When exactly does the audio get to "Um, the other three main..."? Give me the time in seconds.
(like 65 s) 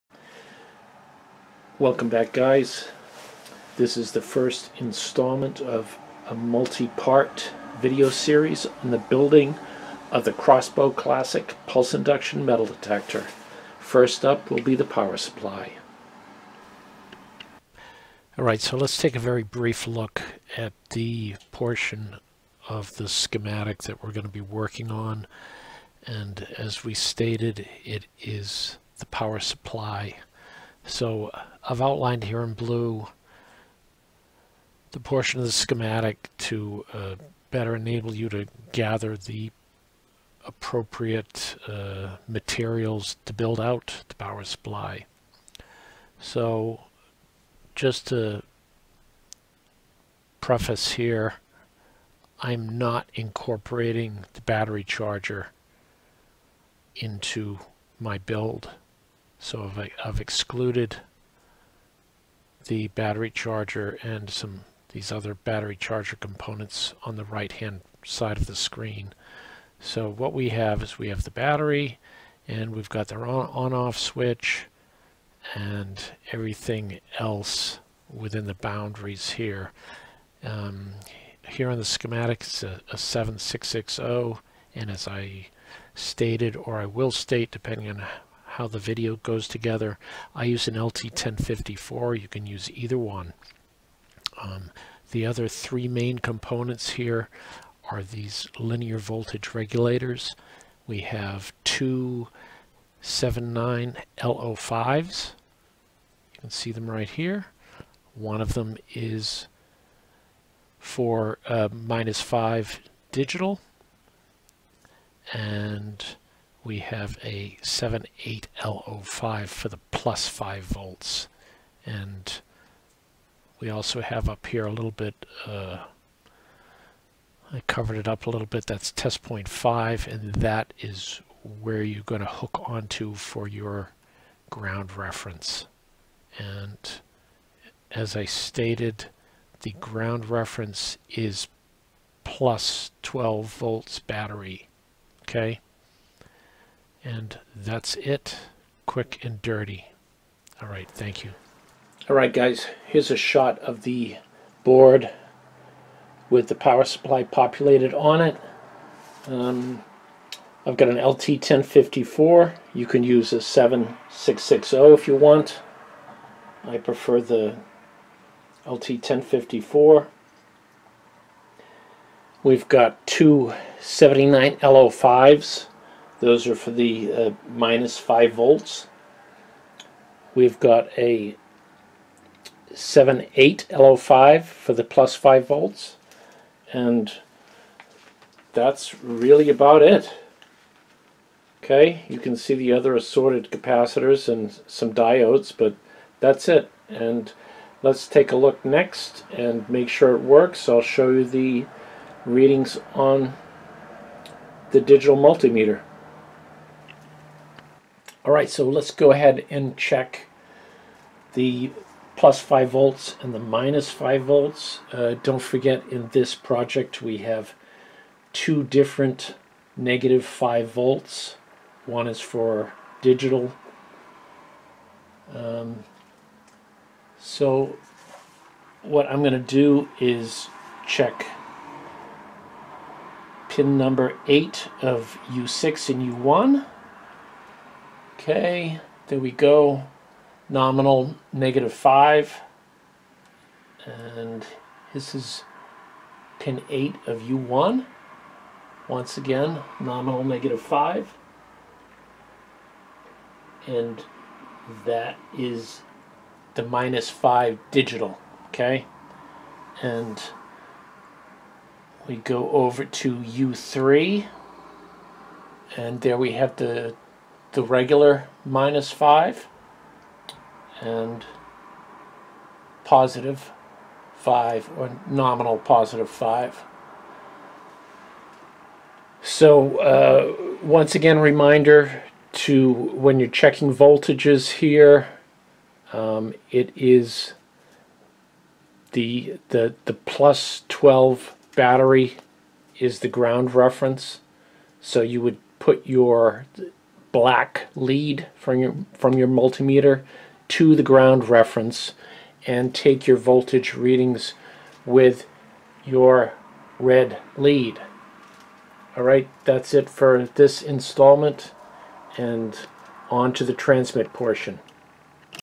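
94 s.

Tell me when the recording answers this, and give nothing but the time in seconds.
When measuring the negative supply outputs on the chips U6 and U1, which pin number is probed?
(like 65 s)
233 s.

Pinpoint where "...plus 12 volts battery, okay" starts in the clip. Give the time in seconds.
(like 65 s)
142 s.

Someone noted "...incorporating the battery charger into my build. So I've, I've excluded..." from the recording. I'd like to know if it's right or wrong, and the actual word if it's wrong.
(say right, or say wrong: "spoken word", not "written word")
right.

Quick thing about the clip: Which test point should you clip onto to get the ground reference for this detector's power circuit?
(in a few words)
test point 5.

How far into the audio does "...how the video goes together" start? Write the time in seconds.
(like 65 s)
88 s.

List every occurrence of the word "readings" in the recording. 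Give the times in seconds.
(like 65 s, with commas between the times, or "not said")
202 s, 303 s.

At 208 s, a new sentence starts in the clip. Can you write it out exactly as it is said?
All right, so let's go ahead and check the plus 5 volts and the minus 5 volts.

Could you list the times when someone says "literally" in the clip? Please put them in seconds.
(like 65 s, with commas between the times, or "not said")
not said.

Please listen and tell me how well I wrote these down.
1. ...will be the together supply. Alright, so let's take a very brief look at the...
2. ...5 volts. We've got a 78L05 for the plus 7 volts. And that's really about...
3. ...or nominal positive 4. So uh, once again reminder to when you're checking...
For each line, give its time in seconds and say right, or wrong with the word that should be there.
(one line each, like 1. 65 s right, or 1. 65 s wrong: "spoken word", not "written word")
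1. 14 s wrong: "power", not "together"
2. 177 s wrong: "5", not "7"
3. 274 s wrong: "5", not "4".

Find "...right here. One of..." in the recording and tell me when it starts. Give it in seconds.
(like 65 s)
106 s.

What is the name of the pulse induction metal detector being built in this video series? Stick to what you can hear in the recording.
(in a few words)
Crossbow Classic.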